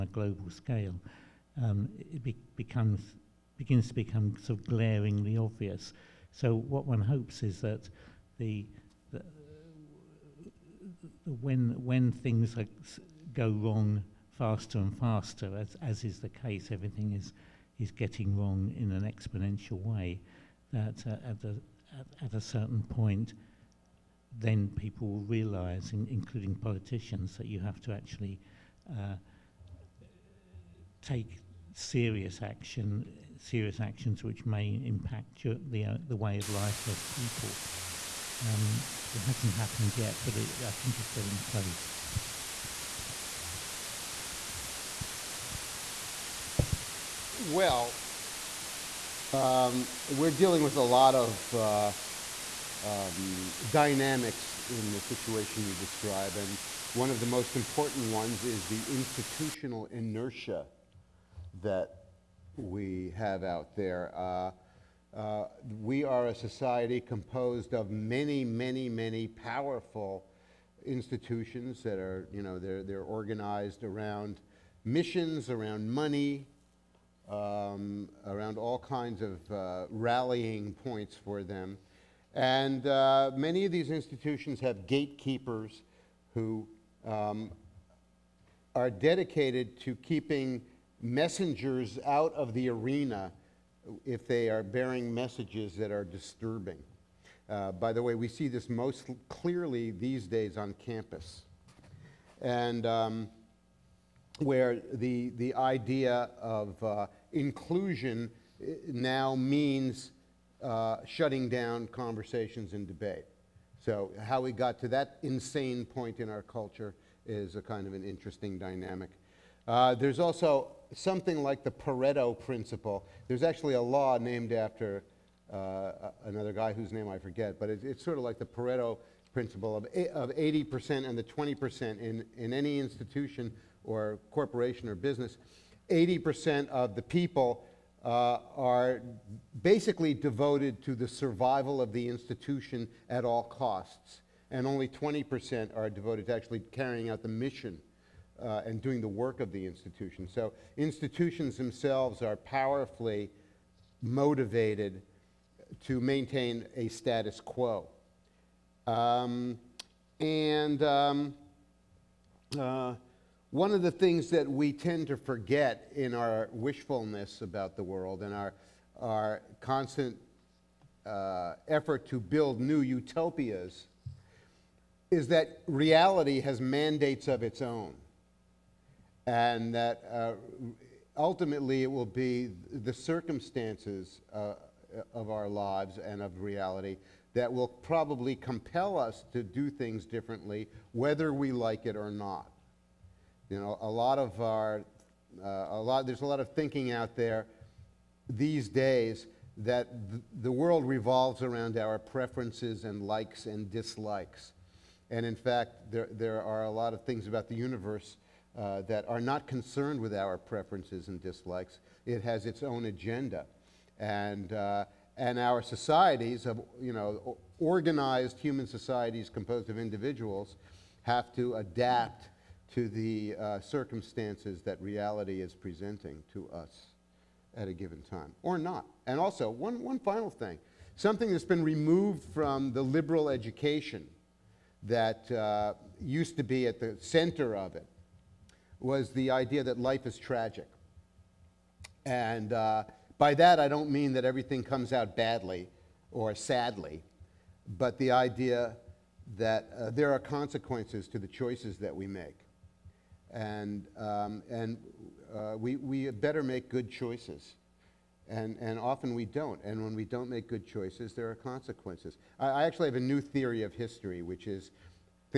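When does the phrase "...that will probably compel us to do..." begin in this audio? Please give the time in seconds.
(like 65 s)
187 s.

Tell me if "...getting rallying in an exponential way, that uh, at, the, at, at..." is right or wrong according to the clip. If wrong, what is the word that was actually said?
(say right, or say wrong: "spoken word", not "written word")
wrong: "wrong", not "rallying".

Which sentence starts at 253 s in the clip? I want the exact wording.
And, um, and uh, we, we better make good choices.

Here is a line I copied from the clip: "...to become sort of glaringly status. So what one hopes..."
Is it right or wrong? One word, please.
wrong.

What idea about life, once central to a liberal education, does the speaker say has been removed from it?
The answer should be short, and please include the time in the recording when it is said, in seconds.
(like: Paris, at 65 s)
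Life is tragic, at 239 s.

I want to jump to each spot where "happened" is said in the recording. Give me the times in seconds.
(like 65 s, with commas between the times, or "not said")
39 s.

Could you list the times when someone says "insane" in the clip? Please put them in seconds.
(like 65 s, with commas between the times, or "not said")
115 s.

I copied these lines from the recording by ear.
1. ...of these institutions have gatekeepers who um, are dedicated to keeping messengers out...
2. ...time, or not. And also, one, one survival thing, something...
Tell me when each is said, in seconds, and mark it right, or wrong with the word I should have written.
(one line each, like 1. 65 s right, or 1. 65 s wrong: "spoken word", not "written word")
1. 83 s right
2. 228 s wrong: "final", not "survival".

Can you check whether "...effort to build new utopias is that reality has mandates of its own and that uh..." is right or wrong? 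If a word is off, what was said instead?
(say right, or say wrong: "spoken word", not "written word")
right.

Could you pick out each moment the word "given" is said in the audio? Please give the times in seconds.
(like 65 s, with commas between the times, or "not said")
227 s.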